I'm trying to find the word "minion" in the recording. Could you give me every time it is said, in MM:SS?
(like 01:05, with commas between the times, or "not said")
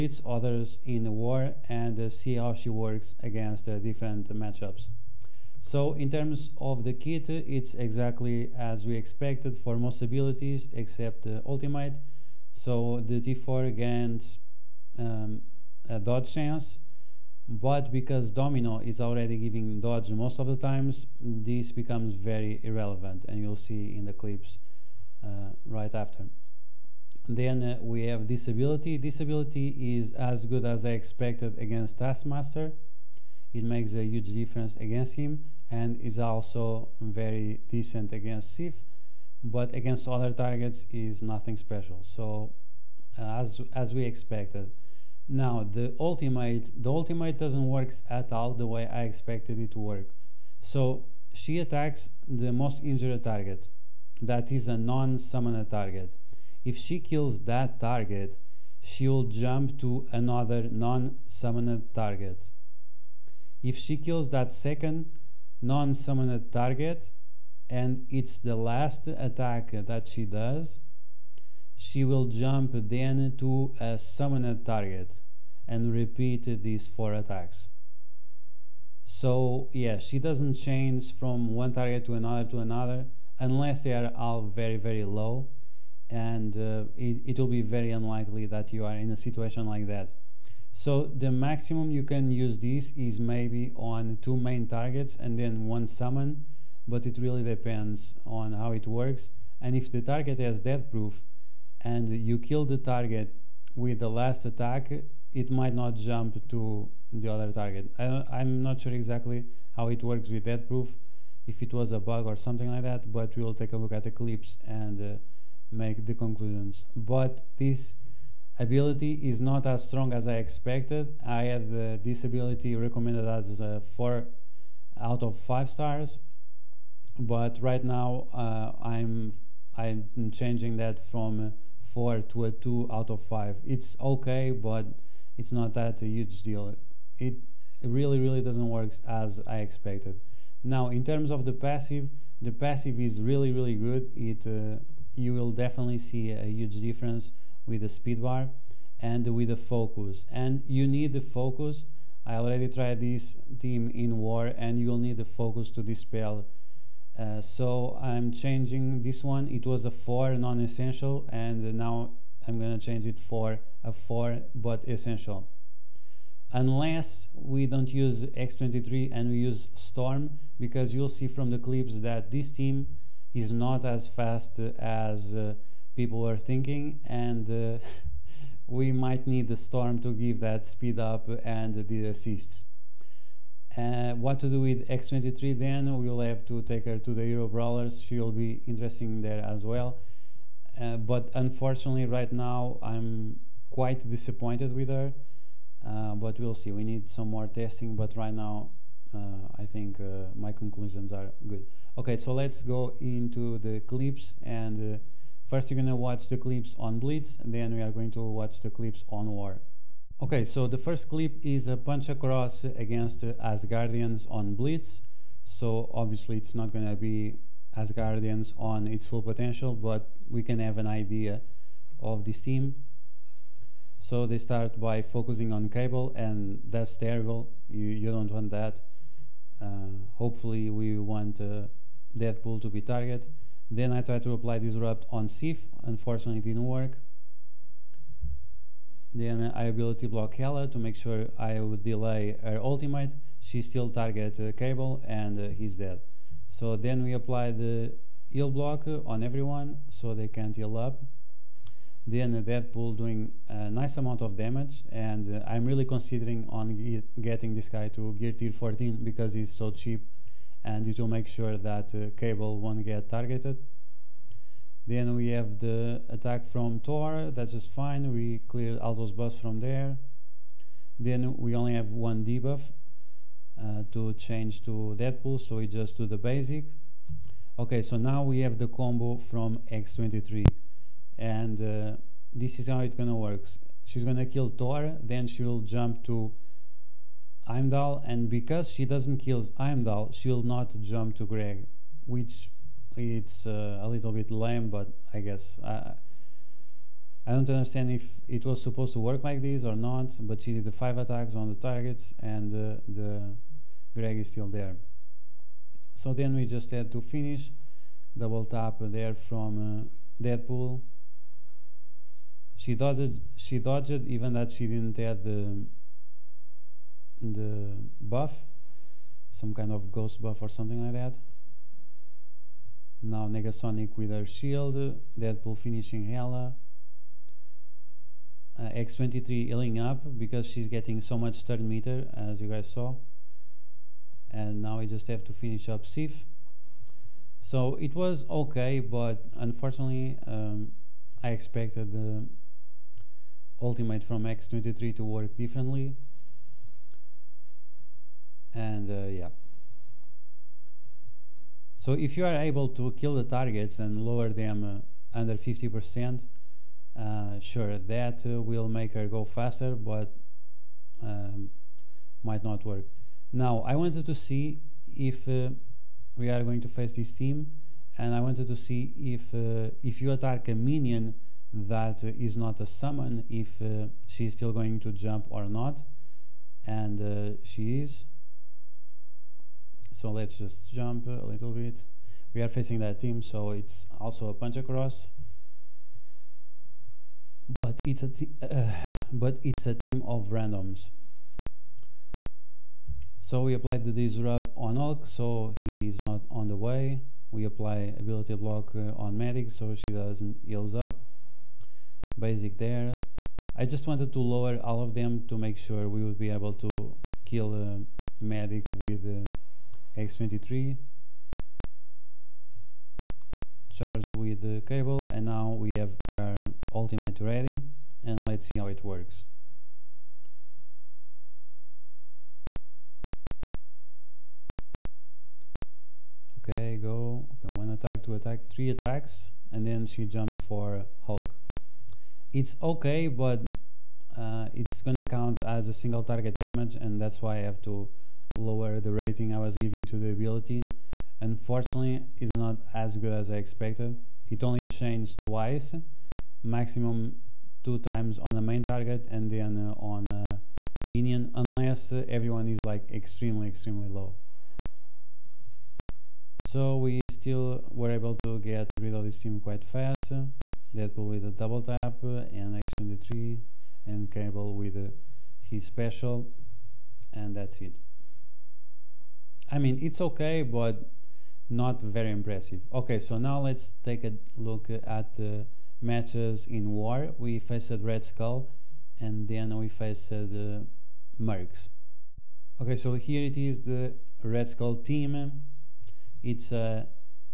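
06:10, 07:30.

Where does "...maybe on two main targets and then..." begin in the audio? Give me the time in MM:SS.
01:33.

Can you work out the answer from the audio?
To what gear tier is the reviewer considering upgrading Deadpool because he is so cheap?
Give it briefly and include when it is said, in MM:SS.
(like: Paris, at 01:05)
14, at 04:18.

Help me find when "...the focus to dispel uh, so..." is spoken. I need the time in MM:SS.
02:35.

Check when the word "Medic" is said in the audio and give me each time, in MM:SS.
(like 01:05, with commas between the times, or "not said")
06:39, 06:48.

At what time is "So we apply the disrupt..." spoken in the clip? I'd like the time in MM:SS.
06:33.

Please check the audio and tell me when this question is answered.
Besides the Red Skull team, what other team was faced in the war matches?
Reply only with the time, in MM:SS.
08:01.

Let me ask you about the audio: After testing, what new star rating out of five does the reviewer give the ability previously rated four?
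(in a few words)
2.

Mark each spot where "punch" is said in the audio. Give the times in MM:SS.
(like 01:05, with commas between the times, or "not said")
03:31, 06:24.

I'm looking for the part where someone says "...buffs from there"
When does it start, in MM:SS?
04:29.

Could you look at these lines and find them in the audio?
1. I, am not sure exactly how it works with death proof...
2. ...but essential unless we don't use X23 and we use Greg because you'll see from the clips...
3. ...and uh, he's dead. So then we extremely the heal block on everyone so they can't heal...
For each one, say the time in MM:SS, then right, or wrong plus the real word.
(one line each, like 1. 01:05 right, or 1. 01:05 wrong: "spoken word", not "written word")
1. 01:47 right
2. 02:44 wrong: "Storm", not "Greg"
3. 04:05 wrong: "apply", not "extremely".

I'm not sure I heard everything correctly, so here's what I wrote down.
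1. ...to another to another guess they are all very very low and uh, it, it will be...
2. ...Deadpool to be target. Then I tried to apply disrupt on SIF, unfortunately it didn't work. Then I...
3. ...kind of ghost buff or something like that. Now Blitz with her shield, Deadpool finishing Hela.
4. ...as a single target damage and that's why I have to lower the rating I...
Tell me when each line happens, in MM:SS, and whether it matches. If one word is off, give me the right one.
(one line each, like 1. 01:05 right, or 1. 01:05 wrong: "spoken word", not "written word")
1. 01:22 wrong: "unless", not "guess"
2. 03:52 right
3. 05:19 wrong: "Negasonic", not "Blitz"
4. 07:15 right.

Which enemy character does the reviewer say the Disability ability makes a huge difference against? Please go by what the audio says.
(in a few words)
Taskmaster.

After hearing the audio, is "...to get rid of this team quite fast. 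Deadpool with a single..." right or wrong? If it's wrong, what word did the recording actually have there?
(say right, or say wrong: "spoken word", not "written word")
wrong: "double", not "single".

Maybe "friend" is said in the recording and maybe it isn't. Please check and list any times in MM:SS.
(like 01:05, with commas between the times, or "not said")
not said.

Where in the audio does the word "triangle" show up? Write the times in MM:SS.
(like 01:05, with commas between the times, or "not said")
not said.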